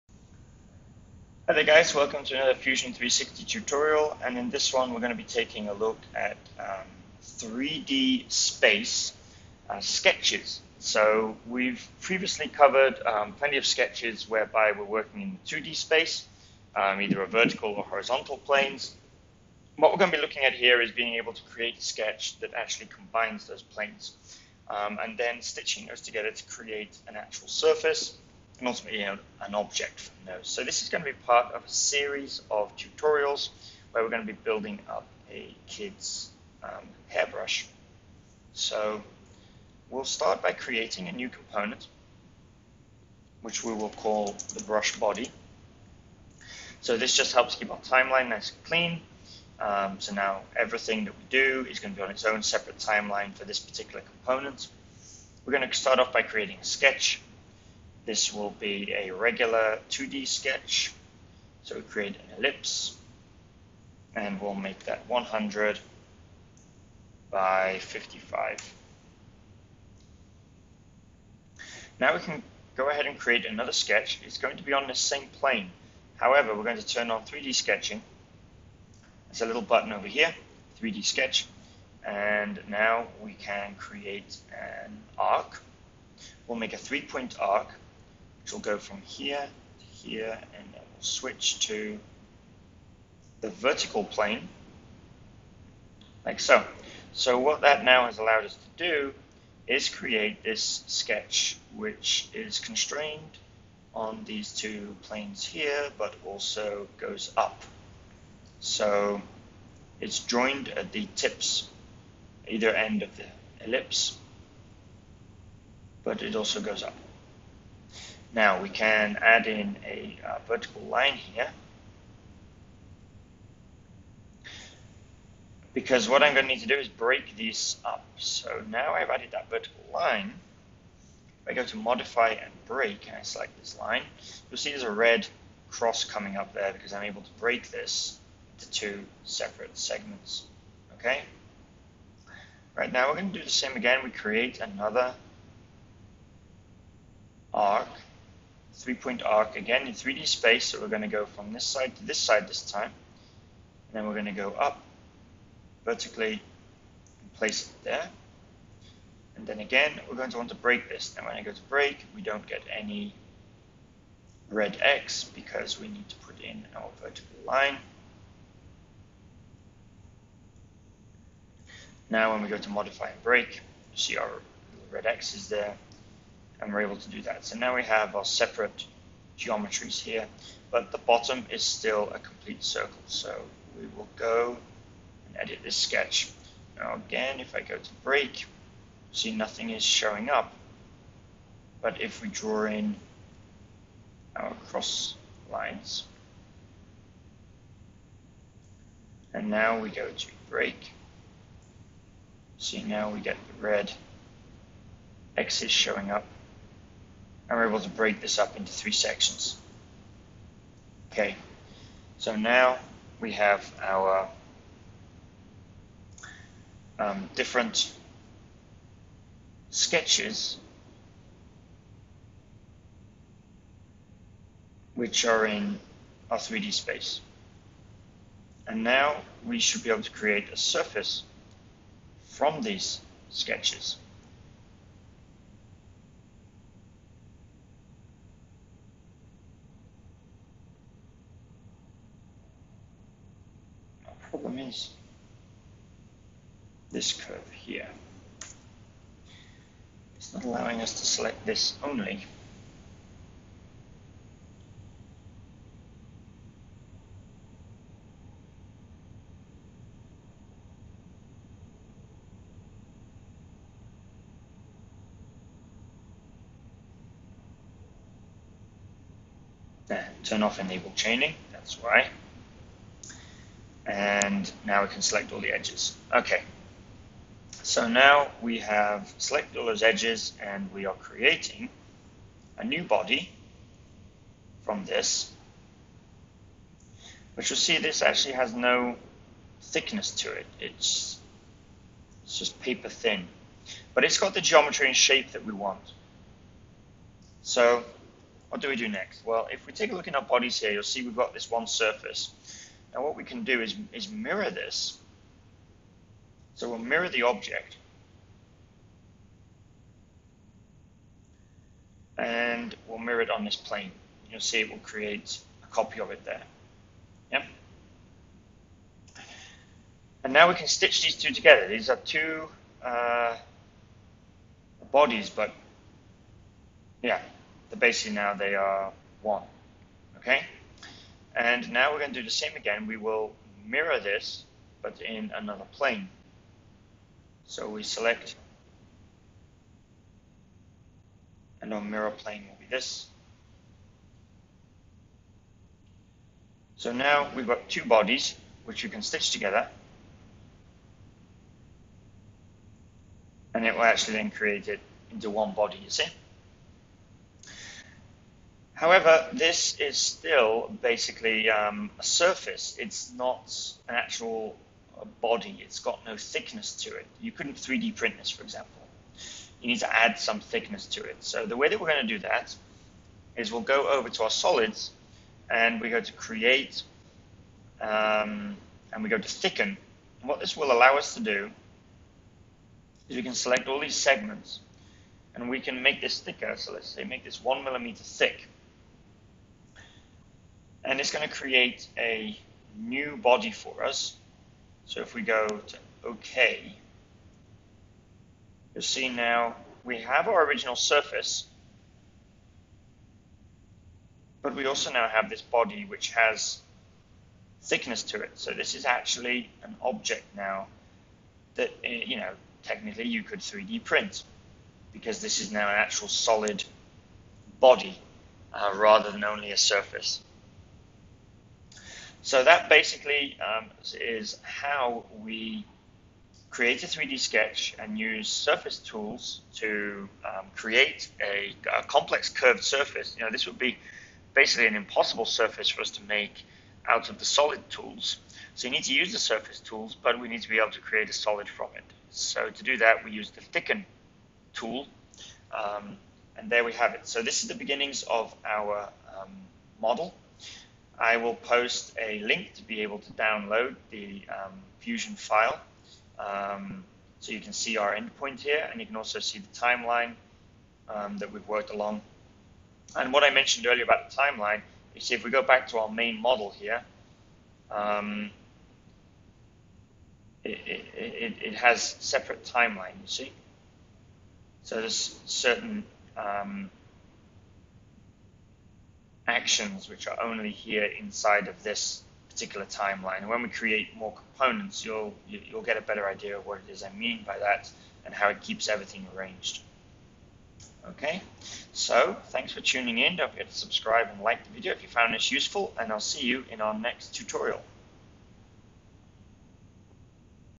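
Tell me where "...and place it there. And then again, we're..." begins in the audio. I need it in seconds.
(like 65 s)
157 s.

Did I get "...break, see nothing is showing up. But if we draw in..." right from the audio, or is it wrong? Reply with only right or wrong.
right.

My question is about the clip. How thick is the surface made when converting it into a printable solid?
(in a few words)
1 millimeter.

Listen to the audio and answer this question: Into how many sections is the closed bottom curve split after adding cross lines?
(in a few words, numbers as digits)
3.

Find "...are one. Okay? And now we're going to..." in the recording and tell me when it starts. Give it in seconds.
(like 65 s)
328 s.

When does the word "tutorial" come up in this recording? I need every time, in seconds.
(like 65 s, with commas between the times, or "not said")
3 s, 32 s, 497 s.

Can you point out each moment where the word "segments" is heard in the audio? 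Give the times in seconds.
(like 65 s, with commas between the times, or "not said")
139 s, 383 s.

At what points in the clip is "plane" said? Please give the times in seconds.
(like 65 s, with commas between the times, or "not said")
18 s, 23 s, 75 s, 94 s, 105 s, 313 s, 335 s, 342 s.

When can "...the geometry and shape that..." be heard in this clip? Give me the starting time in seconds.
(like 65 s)
294 s.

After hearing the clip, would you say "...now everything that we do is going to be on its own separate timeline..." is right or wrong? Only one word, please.
right.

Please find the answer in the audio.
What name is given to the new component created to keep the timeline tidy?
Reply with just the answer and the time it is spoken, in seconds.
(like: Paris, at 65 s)
brush body, at 44 s.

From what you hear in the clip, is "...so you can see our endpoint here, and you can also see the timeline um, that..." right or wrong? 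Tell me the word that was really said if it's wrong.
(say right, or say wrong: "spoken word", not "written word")
right.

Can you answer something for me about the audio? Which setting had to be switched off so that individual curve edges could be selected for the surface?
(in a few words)
enable chaining.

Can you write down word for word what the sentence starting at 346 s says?
So now we've got two bodies, which you can stitch together.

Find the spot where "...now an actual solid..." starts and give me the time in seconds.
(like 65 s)
415 s.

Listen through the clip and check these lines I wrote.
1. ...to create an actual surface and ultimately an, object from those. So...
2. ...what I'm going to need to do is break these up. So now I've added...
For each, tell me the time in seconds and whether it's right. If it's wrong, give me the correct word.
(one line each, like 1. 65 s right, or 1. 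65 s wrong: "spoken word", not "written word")
1. 26 s right
2. 126 s right.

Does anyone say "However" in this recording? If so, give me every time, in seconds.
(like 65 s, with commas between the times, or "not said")
76 s, 358 s.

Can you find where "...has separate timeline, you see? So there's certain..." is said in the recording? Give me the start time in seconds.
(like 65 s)
471 s.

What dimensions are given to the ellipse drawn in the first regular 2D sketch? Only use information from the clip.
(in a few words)
100 by 55.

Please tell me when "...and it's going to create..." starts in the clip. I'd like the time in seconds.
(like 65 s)
390 s.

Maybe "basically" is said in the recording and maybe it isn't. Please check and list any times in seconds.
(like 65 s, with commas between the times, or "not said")
327 s, 360 s, 422 s, 434 s.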